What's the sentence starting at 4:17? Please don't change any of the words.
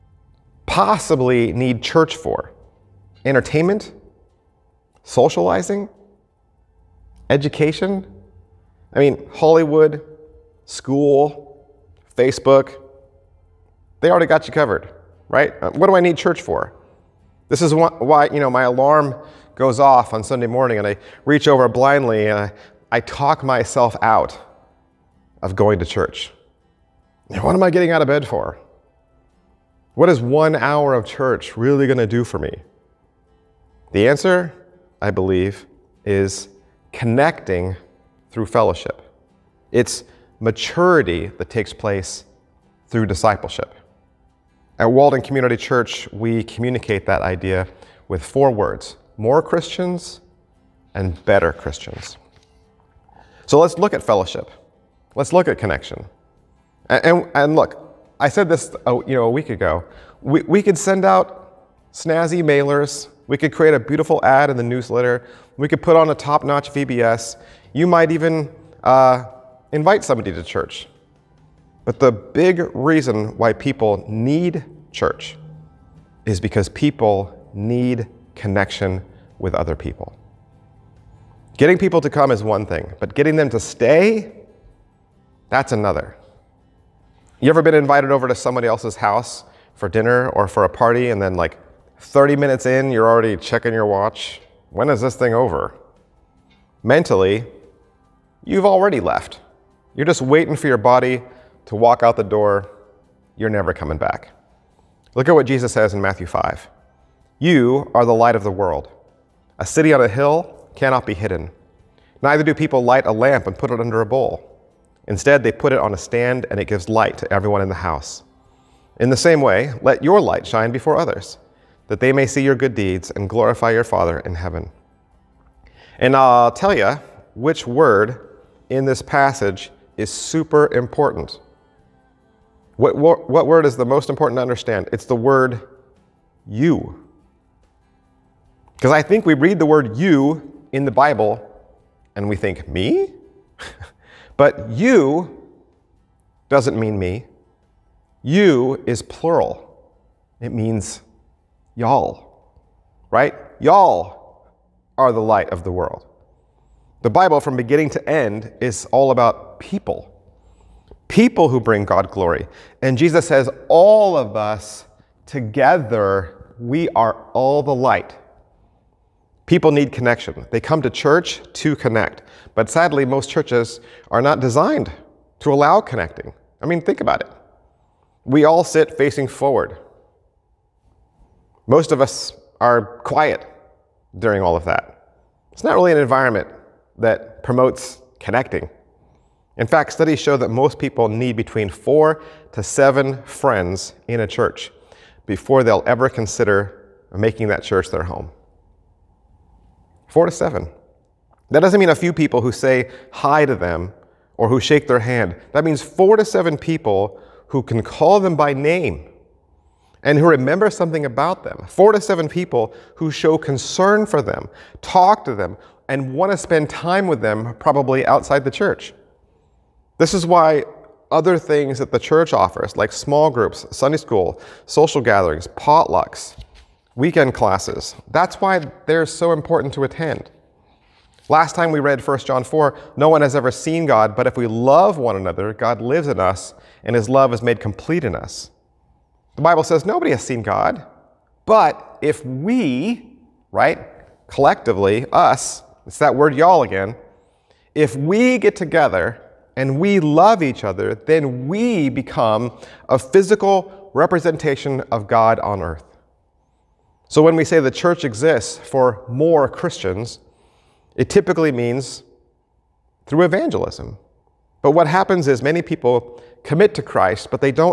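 So when we say the church exists for more Christians, it typically means through evangelism.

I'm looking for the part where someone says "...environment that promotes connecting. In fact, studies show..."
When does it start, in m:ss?
3:05.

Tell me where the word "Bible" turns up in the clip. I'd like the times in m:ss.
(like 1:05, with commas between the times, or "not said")
2:20, 2:37, 3:59.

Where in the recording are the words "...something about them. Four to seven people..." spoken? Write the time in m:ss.
3:30.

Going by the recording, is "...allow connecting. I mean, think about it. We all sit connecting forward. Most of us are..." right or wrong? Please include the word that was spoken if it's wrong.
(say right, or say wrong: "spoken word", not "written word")
wrong: "facing", not "connecting".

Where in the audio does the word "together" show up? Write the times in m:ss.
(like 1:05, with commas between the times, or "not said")
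2:45, 4:08.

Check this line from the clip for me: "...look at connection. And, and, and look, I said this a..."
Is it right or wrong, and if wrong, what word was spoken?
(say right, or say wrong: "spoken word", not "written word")
right.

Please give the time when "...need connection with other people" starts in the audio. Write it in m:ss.
1:17.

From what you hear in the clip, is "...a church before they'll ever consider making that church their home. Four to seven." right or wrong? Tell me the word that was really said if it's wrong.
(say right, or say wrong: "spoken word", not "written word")
right.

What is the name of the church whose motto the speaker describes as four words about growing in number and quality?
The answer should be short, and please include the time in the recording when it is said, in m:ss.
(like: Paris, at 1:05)
Walden Community Church, at 0:44.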